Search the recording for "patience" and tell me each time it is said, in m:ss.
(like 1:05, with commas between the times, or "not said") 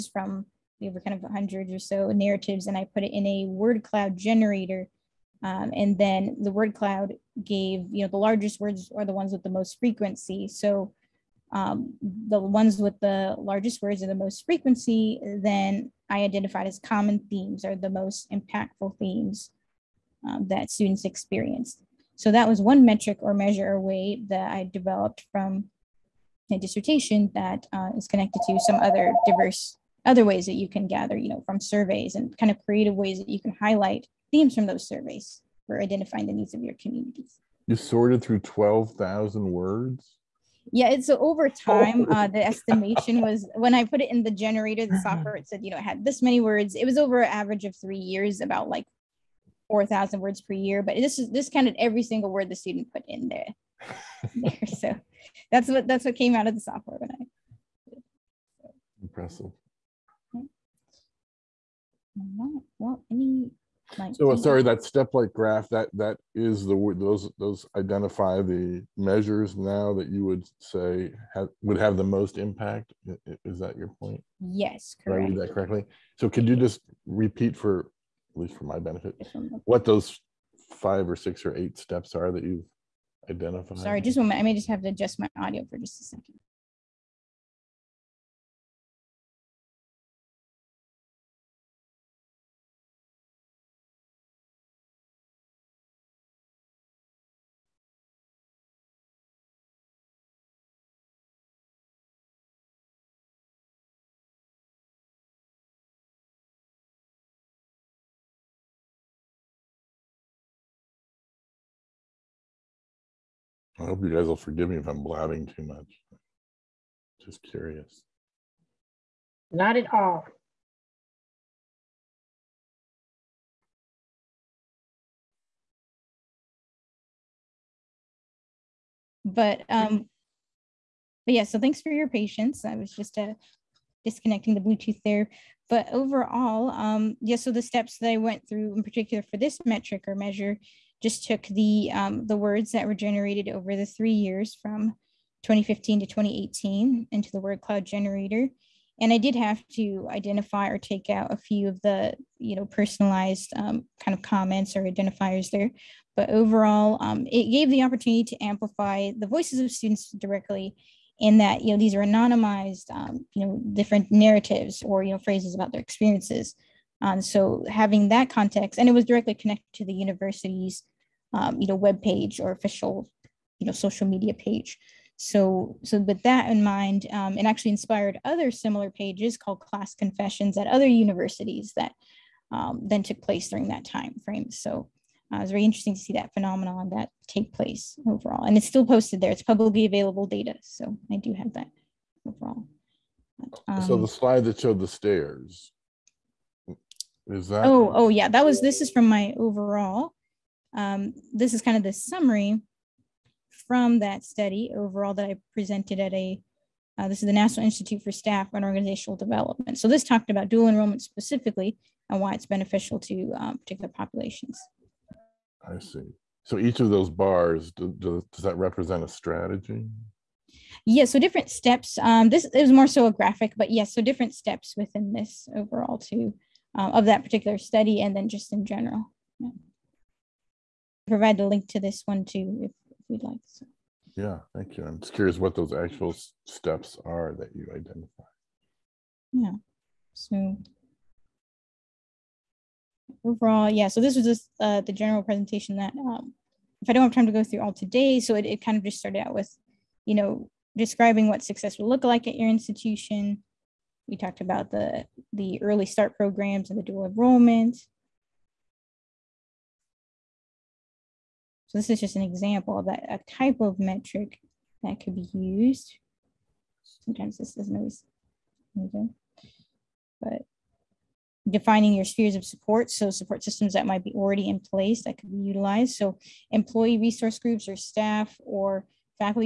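2:12.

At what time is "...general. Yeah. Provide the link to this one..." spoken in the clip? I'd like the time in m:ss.
3:48.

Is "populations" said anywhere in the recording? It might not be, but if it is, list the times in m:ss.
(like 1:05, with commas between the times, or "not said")
3:33.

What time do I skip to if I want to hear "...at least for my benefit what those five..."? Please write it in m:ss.
1:18.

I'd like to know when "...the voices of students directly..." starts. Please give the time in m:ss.
2:39.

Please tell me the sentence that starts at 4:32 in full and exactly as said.
So support systems that might be already in place that could be utilized.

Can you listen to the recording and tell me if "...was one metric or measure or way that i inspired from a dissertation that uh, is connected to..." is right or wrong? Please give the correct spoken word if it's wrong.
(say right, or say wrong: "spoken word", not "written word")
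wrong: "developed", not "inspired".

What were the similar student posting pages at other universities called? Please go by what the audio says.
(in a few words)
class confessions.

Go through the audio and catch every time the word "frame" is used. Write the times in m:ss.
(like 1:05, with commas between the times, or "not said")
3:04.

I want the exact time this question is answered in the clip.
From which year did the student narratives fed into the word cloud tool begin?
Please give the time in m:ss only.
2:25.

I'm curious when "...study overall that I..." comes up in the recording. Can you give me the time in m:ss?
3:24.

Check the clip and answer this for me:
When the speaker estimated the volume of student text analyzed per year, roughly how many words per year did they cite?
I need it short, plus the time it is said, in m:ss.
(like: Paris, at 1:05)
4,000 words, at 0:49.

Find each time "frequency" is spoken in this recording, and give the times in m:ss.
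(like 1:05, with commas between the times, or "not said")
0:09, 0:14.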